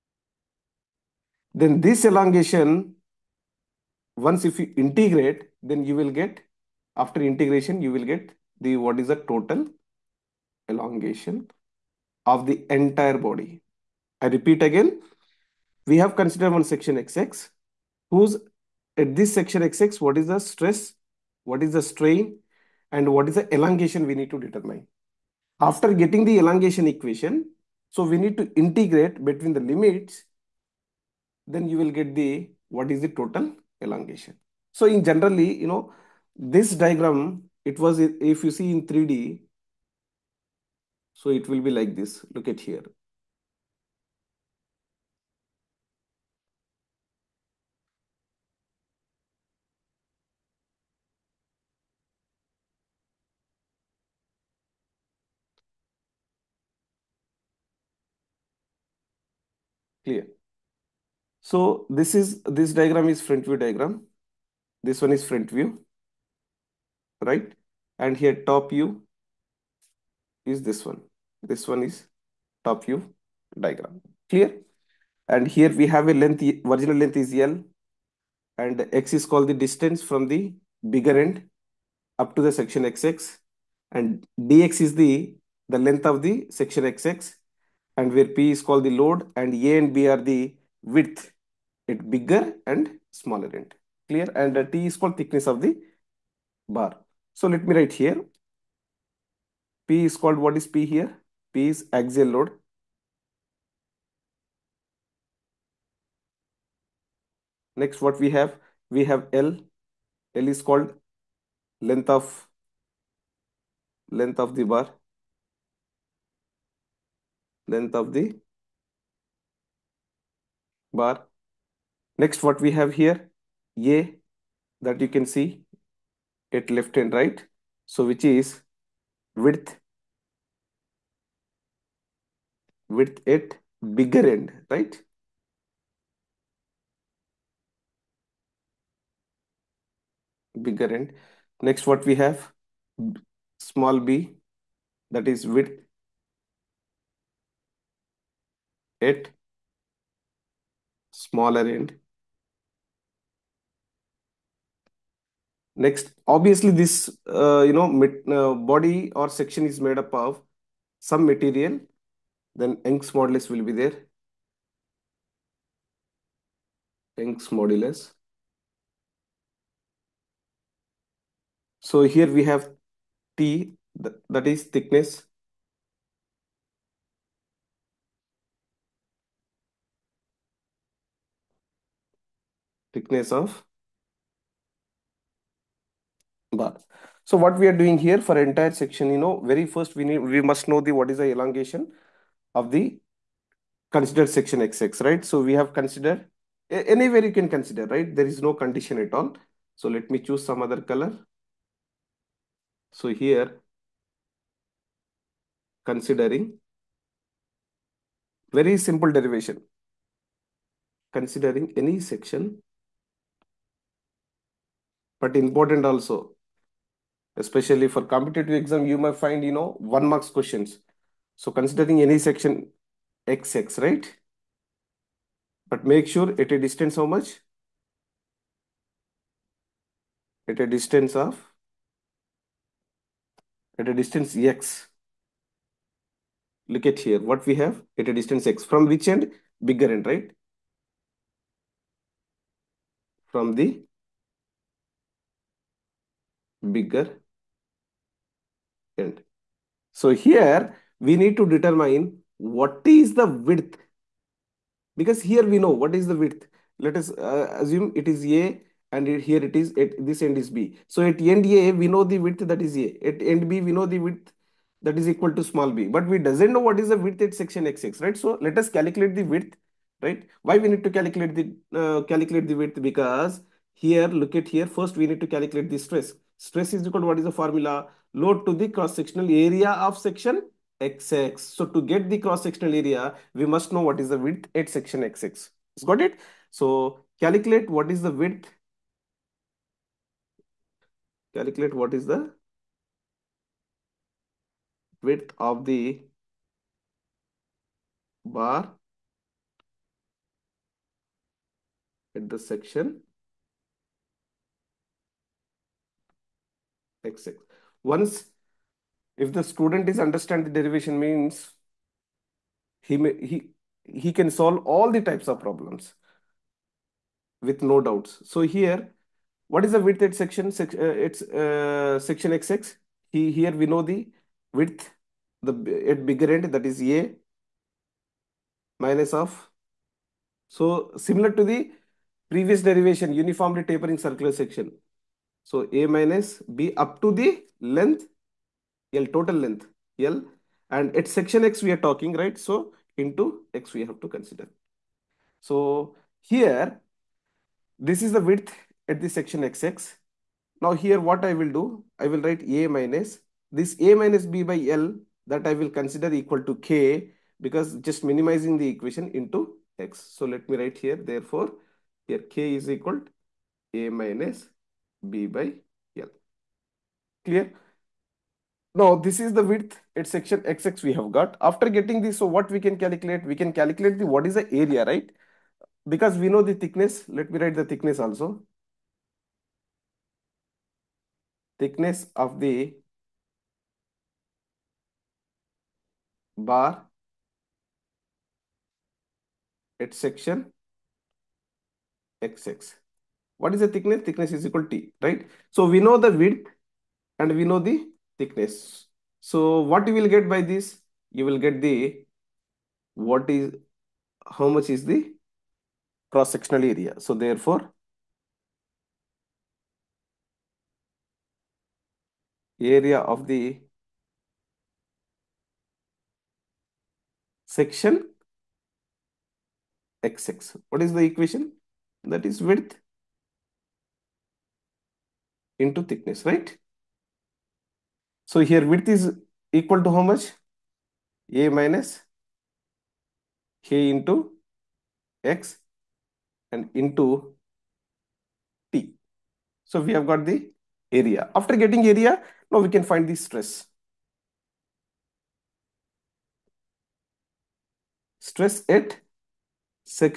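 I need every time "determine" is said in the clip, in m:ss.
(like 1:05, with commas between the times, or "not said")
0:24, 4:11.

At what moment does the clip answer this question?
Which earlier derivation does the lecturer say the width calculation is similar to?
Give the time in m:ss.
5:33.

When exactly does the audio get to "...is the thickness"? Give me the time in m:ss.
6:33.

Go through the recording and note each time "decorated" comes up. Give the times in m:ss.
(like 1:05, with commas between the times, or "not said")
not said.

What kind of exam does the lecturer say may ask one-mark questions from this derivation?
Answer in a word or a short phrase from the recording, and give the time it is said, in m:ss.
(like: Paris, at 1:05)
Competitive exam, at 3:38.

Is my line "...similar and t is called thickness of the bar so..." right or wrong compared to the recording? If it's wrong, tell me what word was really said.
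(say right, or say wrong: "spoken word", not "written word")
wrong: "clear", not "similar".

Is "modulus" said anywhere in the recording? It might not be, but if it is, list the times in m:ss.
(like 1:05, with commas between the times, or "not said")
2:43, 2:47.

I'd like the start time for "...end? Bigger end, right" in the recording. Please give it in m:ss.
3:59.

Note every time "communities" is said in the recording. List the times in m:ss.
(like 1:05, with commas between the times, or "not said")
not said.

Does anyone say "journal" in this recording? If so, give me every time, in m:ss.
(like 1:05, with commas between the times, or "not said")
not said.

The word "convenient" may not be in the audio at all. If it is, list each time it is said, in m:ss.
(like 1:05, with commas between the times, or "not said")
not said.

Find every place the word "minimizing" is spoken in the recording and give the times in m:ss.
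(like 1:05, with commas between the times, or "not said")
5:58.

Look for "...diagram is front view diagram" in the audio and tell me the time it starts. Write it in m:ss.
1:02.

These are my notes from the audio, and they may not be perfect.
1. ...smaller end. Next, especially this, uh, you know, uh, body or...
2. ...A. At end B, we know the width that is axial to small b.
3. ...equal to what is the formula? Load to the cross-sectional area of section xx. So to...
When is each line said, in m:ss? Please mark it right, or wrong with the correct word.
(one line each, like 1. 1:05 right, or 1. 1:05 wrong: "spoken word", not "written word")
1. 2:31 wrong: "obviously", not "especially"
2. 4:22 wrong: "equal", not "axial"
3. 4:36 right.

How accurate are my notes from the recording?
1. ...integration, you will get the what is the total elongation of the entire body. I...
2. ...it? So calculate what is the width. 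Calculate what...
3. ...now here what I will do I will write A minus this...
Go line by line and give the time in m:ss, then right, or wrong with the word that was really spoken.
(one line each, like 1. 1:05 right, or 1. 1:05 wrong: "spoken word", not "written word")
1. 0:07 right
2. 4:46 right
3. 5:50 right.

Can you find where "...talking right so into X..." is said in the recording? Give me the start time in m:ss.
5:41.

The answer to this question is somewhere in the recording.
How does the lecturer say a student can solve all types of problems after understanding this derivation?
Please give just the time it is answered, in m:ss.
5:17.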